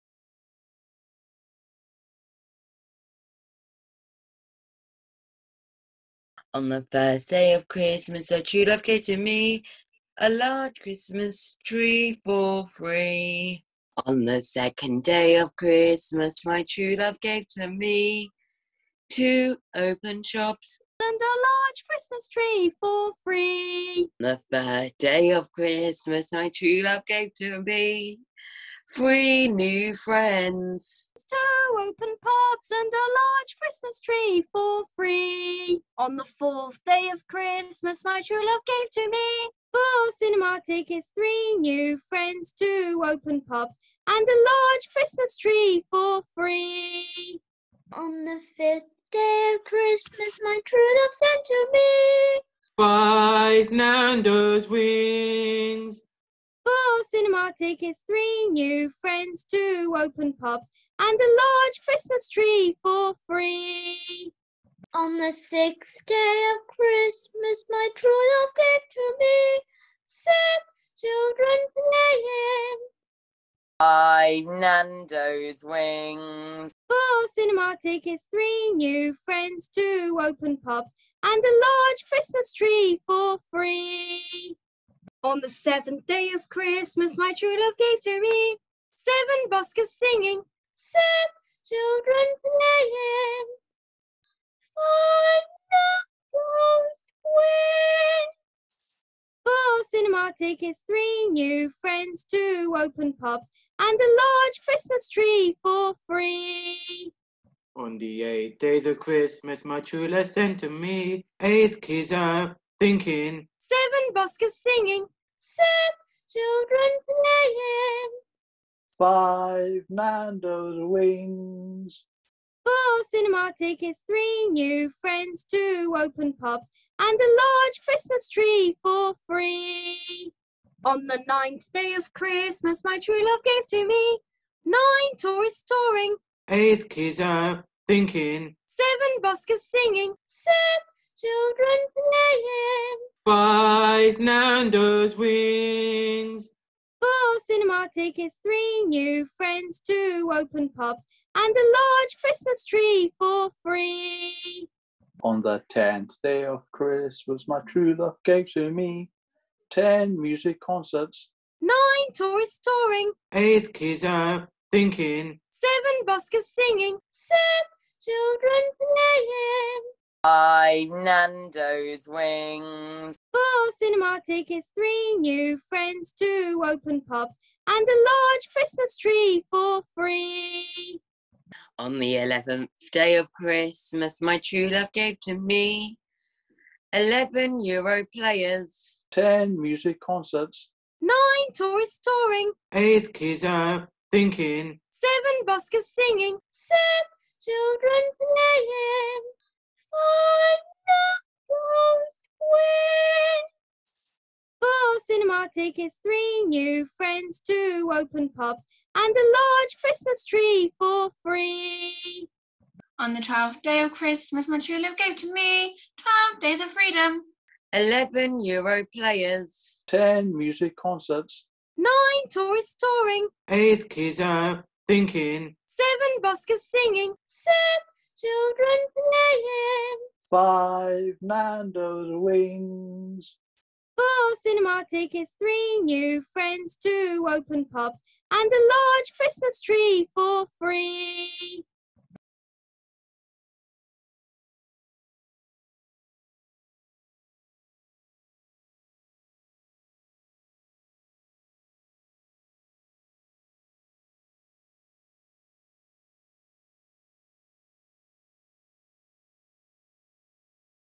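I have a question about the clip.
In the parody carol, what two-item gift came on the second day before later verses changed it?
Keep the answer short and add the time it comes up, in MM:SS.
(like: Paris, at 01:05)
two open shops, at 00:19.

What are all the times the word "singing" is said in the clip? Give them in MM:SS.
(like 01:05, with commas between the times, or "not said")
01:29, 01:54, 02:19, 02:46, 03:15, 03:46.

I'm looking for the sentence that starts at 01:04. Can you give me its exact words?
On the sixth day of Christmas, my true love gave to me six children playing.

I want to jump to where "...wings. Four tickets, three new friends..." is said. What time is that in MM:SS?
01:37.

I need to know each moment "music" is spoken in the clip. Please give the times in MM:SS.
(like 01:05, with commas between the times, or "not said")
02:40, 03:09, 03:40.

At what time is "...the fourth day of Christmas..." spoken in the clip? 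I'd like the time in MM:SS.
00:36.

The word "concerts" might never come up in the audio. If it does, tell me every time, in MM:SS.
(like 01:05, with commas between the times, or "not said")
02:40, 03:09, 03:40.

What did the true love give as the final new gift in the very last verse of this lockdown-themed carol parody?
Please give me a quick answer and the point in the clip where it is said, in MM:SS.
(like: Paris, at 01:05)
12 days of freedom, at 03:35.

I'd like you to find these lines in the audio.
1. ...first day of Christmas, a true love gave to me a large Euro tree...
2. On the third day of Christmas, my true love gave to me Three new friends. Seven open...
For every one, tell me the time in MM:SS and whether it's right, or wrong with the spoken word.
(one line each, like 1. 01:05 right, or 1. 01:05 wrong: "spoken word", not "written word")
1. 00:06 wrong: "Christmas", not "Euro"
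2. 00:24 wrong: "Two", not "Seven".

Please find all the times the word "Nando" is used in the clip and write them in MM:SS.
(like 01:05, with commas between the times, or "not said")
00:53, 01:14, 01:59, 02:24, 02:51, 03:51.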